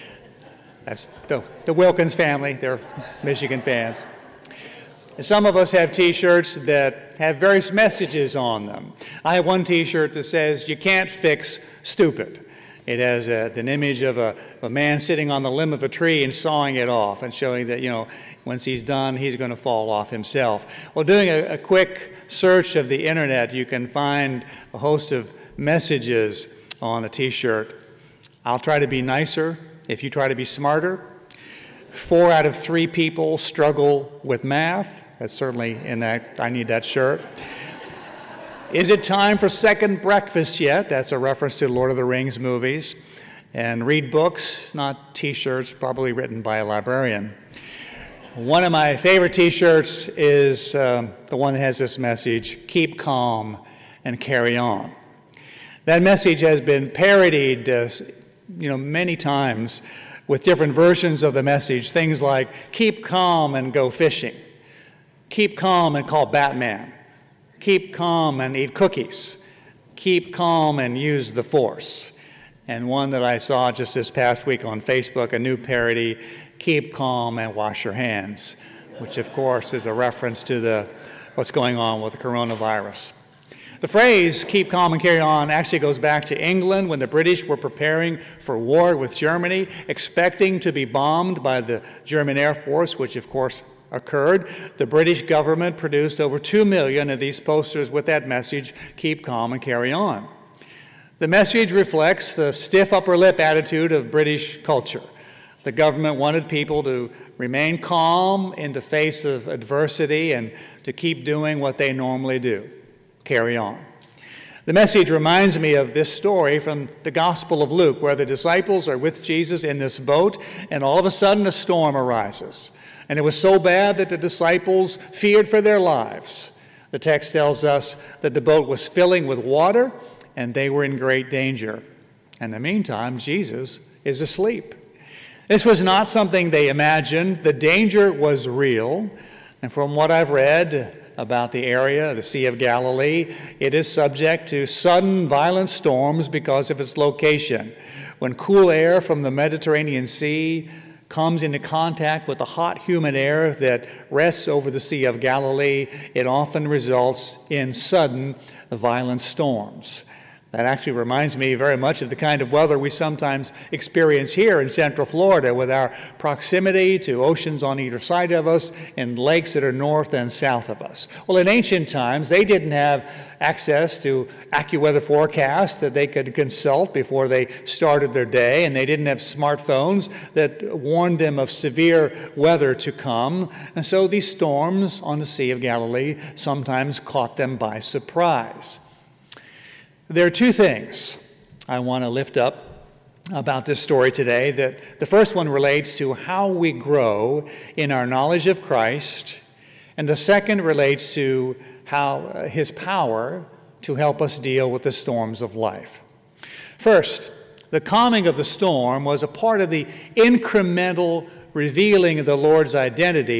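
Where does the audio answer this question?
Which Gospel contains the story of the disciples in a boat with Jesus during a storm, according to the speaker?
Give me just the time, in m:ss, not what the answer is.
1:57.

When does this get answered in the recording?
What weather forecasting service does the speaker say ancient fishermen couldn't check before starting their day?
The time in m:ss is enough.
2:54.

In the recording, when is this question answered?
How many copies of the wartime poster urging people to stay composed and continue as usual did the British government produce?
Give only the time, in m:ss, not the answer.
1:36.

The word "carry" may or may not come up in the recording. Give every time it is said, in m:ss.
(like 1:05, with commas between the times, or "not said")
0:54, 1:25, 1:39, 1:53.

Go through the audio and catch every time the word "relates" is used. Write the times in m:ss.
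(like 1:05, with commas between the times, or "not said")
3:15, 3:20.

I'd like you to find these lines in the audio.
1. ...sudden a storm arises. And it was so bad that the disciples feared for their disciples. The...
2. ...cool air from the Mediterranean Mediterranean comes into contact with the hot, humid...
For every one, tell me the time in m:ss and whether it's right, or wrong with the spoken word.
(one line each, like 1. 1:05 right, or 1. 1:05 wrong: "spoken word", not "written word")
1. 2:01 wrong: "lives", not "disciples"
2. 2:28 wrong: "Sea", not "Mediterranean".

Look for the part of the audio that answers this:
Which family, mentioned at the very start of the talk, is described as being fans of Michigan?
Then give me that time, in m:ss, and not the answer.
0:01.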